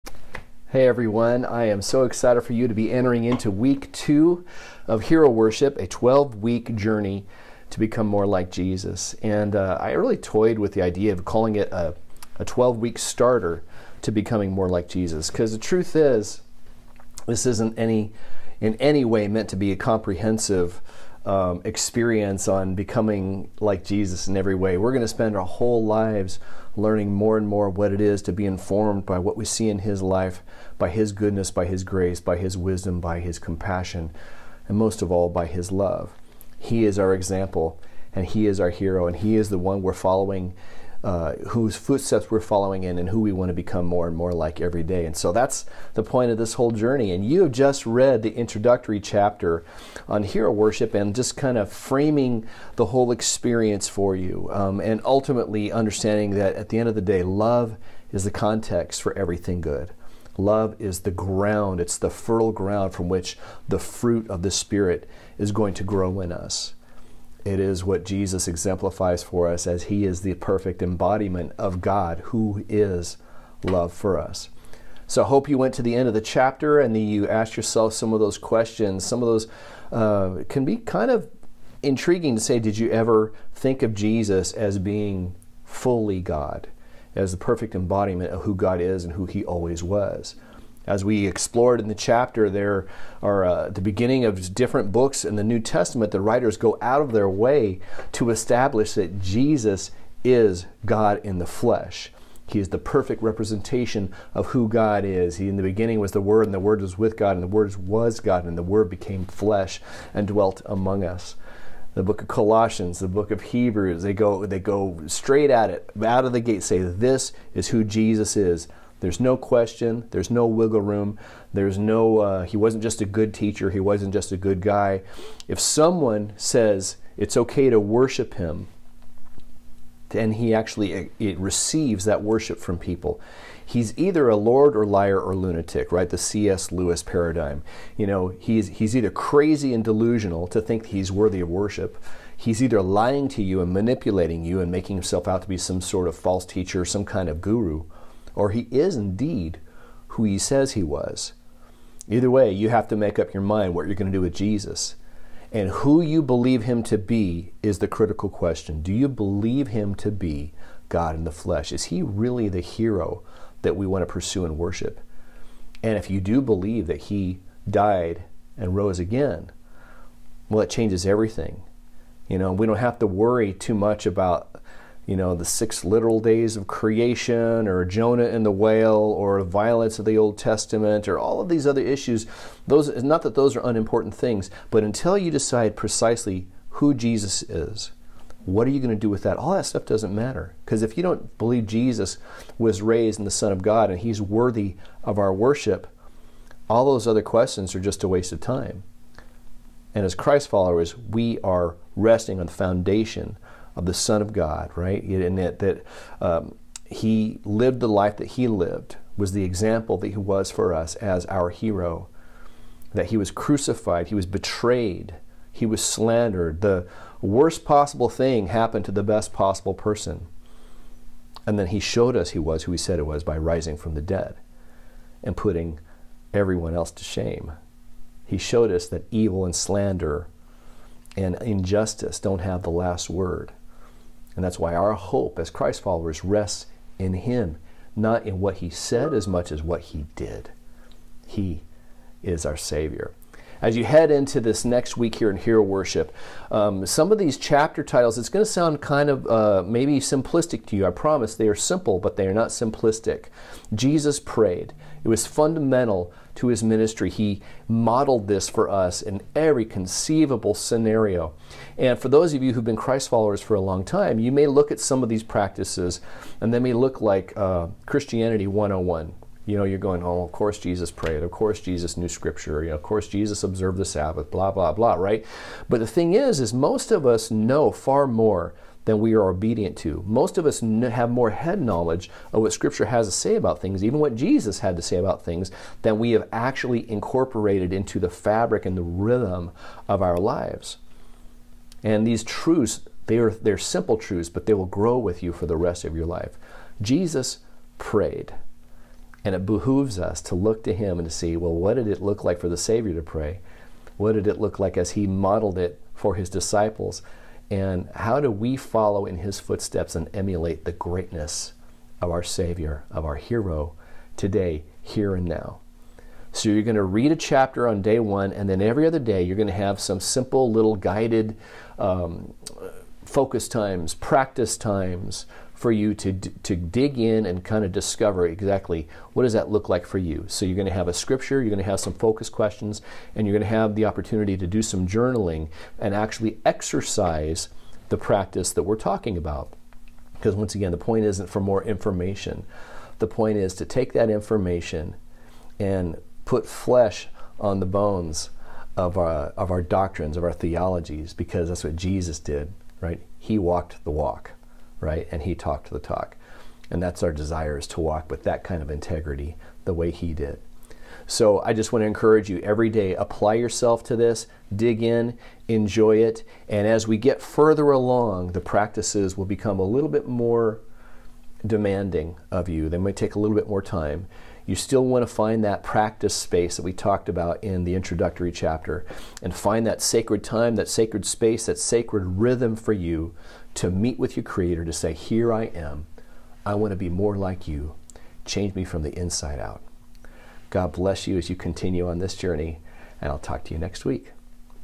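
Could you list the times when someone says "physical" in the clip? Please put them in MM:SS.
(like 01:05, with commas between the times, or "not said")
not said.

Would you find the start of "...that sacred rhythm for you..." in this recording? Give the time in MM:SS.
06:21.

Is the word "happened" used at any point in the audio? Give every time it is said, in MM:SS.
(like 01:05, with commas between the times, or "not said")
03:38.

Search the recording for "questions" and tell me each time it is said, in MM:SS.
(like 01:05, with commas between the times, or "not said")
01:18, 01:59, 02:38, 03:17, 05:32.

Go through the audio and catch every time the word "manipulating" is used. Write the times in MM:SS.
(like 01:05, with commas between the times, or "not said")
02:23.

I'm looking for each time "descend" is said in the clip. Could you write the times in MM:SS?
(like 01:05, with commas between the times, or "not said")
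not said.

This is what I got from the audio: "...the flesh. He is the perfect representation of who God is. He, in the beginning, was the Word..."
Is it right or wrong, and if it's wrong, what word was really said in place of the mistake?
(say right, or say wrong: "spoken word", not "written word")
right.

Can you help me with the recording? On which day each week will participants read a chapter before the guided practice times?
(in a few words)
Day one.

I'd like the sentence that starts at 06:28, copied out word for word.
Change me from the inside out.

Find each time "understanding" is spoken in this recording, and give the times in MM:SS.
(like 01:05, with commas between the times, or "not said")
00:55.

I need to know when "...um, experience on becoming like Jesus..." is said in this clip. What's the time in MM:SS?
00:21.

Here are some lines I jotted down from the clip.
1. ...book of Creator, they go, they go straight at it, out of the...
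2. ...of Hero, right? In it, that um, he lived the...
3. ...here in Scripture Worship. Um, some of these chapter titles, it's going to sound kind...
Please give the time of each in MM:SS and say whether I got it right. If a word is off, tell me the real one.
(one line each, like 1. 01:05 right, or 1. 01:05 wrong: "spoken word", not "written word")
1. 01:53 wrong: "Hebrews", not "Creator"
2. 03:24 wrong: "God", not "Hero"
3. 04:05 wrong: "Hero", not "Scripture".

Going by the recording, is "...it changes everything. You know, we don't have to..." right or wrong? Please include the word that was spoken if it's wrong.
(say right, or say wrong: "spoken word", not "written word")
right.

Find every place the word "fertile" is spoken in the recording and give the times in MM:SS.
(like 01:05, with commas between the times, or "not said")
01:02.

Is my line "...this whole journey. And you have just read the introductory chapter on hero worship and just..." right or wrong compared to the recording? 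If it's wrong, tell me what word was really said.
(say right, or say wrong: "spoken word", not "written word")
right.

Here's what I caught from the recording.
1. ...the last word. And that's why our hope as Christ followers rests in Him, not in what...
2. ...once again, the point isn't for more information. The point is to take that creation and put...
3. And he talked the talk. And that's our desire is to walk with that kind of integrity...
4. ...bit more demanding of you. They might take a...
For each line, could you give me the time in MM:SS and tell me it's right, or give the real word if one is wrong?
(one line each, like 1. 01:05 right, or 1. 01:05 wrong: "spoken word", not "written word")
1. 03:52 right
2. 05:40 wrong: "information", not "creation"
3. 05:55 right
4. 06:09 right.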